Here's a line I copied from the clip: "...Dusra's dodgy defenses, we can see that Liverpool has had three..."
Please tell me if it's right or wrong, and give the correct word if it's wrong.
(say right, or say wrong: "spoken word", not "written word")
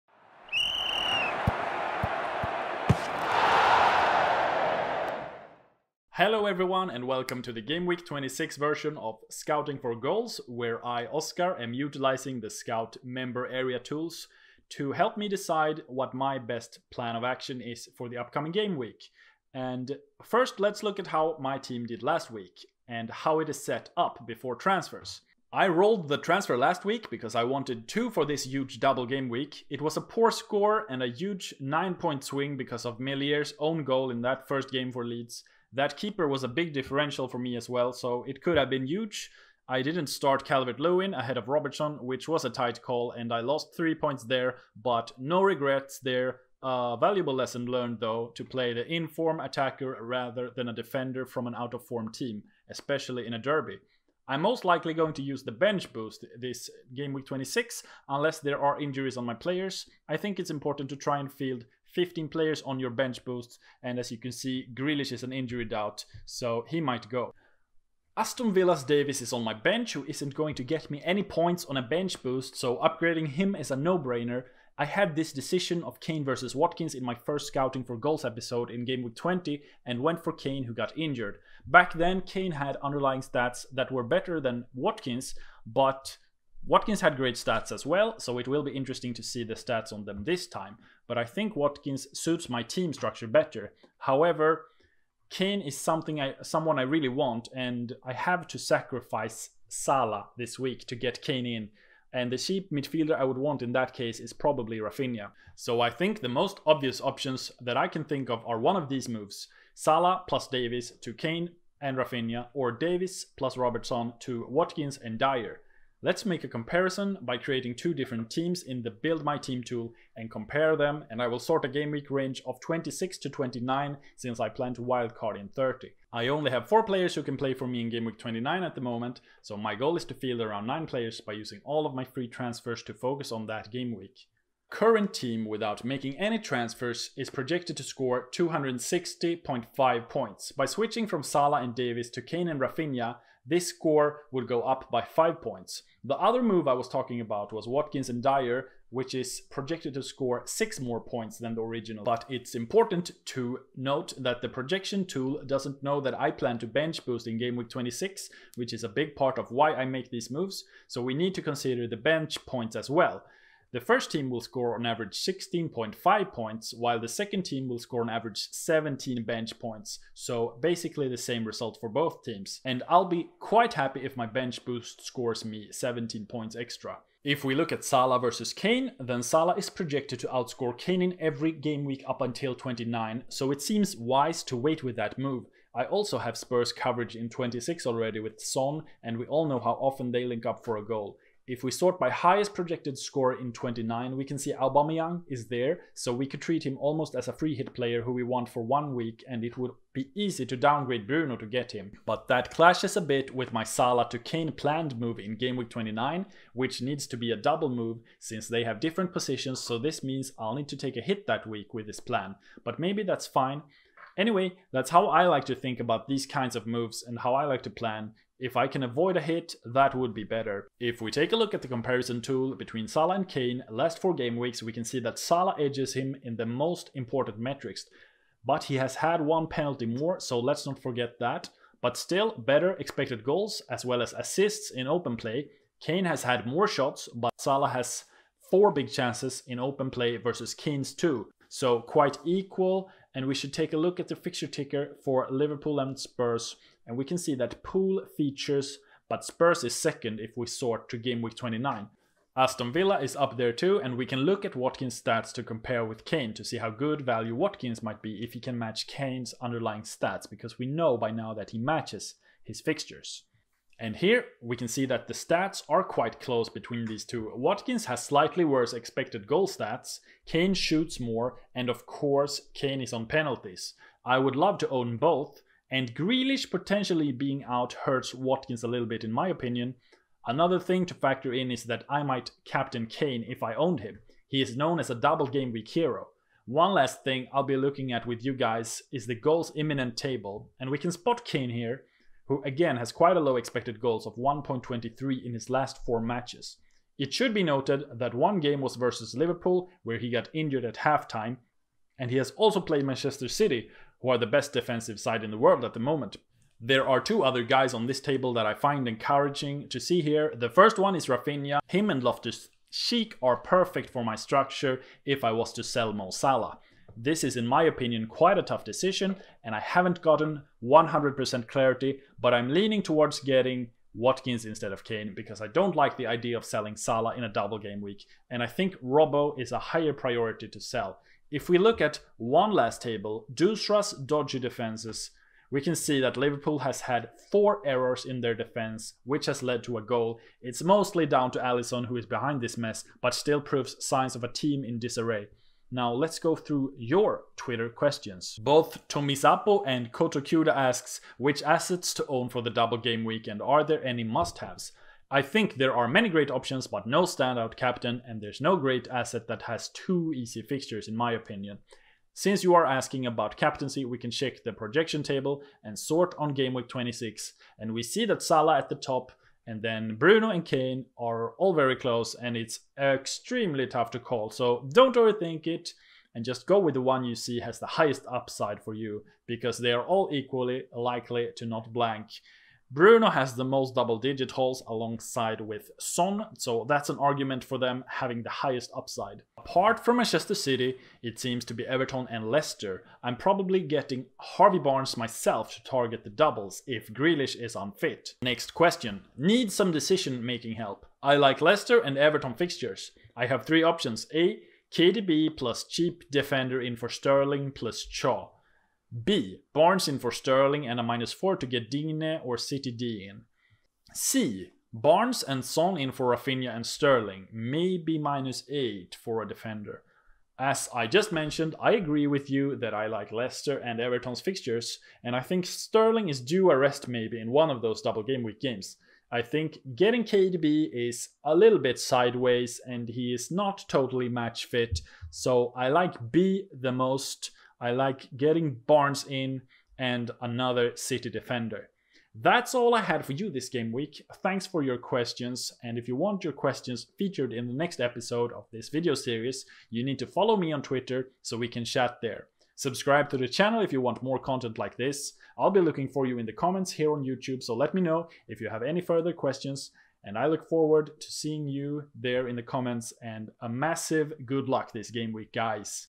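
wrong: "four", not "three".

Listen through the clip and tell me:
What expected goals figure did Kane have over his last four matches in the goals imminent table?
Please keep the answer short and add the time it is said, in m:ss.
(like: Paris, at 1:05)
1.23, at 4:54.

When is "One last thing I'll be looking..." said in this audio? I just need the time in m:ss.
4:46.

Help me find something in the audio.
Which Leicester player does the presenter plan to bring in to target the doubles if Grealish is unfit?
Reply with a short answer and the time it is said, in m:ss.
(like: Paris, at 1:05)
Harvey Barnes, at 6:34.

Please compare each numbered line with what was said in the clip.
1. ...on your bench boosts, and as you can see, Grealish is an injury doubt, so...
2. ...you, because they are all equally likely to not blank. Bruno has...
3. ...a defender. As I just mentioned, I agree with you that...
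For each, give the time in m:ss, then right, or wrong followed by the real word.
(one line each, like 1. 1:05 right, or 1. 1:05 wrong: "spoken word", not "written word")
1. 1:02 right
2. 6:18 right
3. 6:59 right.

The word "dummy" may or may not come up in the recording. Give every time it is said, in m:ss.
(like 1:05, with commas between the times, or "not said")
not said.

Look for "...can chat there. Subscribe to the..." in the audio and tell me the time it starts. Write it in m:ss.
7:31.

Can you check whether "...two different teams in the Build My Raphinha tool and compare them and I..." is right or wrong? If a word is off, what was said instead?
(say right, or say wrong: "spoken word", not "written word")
wrong: "Team", not "Raphinha".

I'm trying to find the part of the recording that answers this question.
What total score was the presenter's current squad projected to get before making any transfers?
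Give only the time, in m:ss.
2:18.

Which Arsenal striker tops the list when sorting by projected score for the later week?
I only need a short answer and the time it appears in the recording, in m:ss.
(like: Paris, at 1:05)
Aubameyang, at 3:14.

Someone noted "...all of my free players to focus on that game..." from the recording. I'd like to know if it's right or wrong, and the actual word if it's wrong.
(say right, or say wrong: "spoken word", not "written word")
wrong: "transfers", not "players".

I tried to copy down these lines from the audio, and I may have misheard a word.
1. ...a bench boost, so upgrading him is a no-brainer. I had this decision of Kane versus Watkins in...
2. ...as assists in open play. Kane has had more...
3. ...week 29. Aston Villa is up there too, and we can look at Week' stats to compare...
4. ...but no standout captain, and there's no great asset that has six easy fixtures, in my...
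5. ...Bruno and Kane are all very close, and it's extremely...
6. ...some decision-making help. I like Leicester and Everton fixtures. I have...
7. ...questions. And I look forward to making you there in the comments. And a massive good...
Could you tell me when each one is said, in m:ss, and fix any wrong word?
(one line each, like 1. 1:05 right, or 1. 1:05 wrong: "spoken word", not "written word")
1. 1:11 right
2. 3:54 right
3. 4:11 wrong: "Watkins", not "Week"
4. 5:56 wrong: "two", not "six"
5. 6:09 right
6. 6:39 right
7. 7:39 wrong: "seeing", not "making".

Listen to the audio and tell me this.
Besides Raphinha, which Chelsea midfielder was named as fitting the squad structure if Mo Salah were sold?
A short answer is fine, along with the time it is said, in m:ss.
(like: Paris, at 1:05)
Loftus Cheek, at 5:12.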